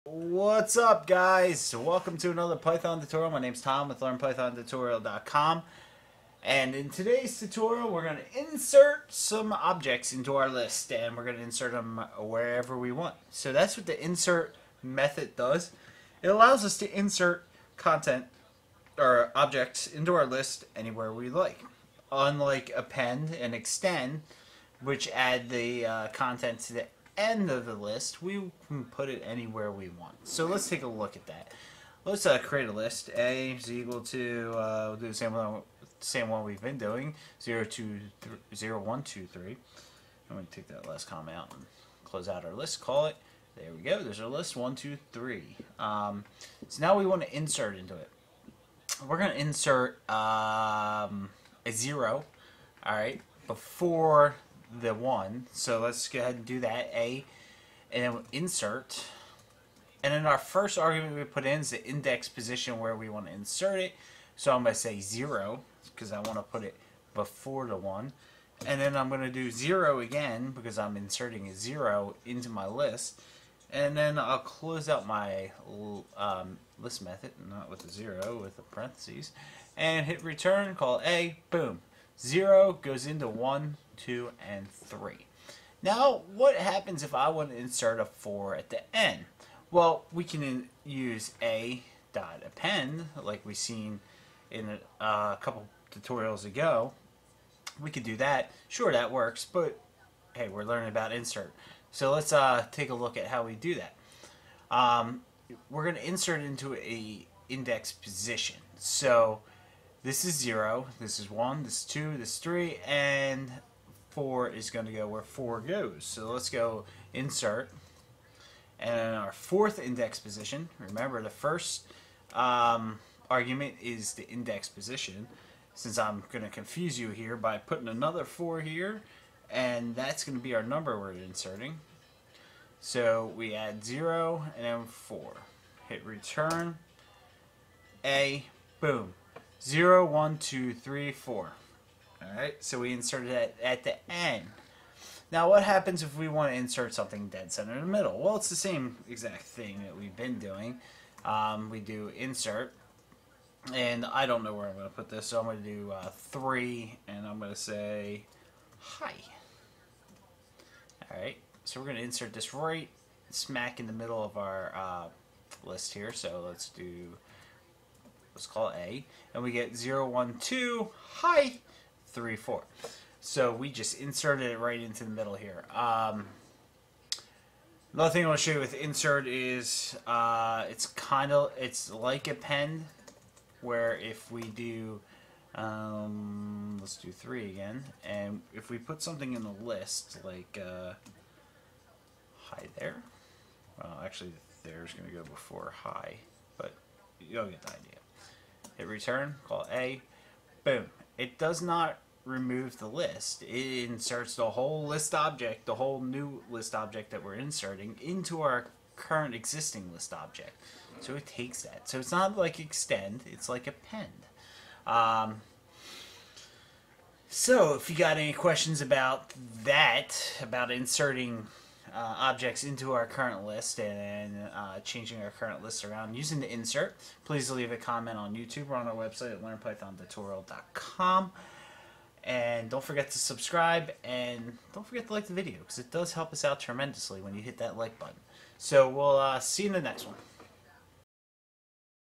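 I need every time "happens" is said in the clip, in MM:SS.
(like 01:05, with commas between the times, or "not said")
01:26, 02:25.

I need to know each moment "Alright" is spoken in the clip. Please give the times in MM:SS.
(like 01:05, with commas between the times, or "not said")
02:20, 02:41.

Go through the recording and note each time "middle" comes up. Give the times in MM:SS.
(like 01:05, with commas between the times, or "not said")
02:27, 02:43, 02:55.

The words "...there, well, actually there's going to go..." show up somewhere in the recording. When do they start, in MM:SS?
03:12.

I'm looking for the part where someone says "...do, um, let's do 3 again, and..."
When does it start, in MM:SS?
03:04.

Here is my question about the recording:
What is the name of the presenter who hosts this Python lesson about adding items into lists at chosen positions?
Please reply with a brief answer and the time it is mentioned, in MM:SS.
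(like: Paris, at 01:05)
Tom, at 00:03.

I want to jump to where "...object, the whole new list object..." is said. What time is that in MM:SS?
03:25.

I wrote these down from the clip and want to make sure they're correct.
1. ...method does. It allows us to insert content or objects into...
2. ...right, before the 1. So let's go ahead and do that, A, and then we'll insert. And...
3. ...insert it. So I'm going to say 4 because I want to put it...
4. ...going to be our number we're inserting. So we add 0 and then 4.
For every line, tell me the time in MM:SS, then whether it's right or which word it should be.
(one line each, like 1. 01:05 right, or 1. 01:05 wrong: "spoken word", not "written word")
1. 00:14 right
2. 00:52 right
3. 01:03 wrong: "0", not "4"
4. 02:10 right.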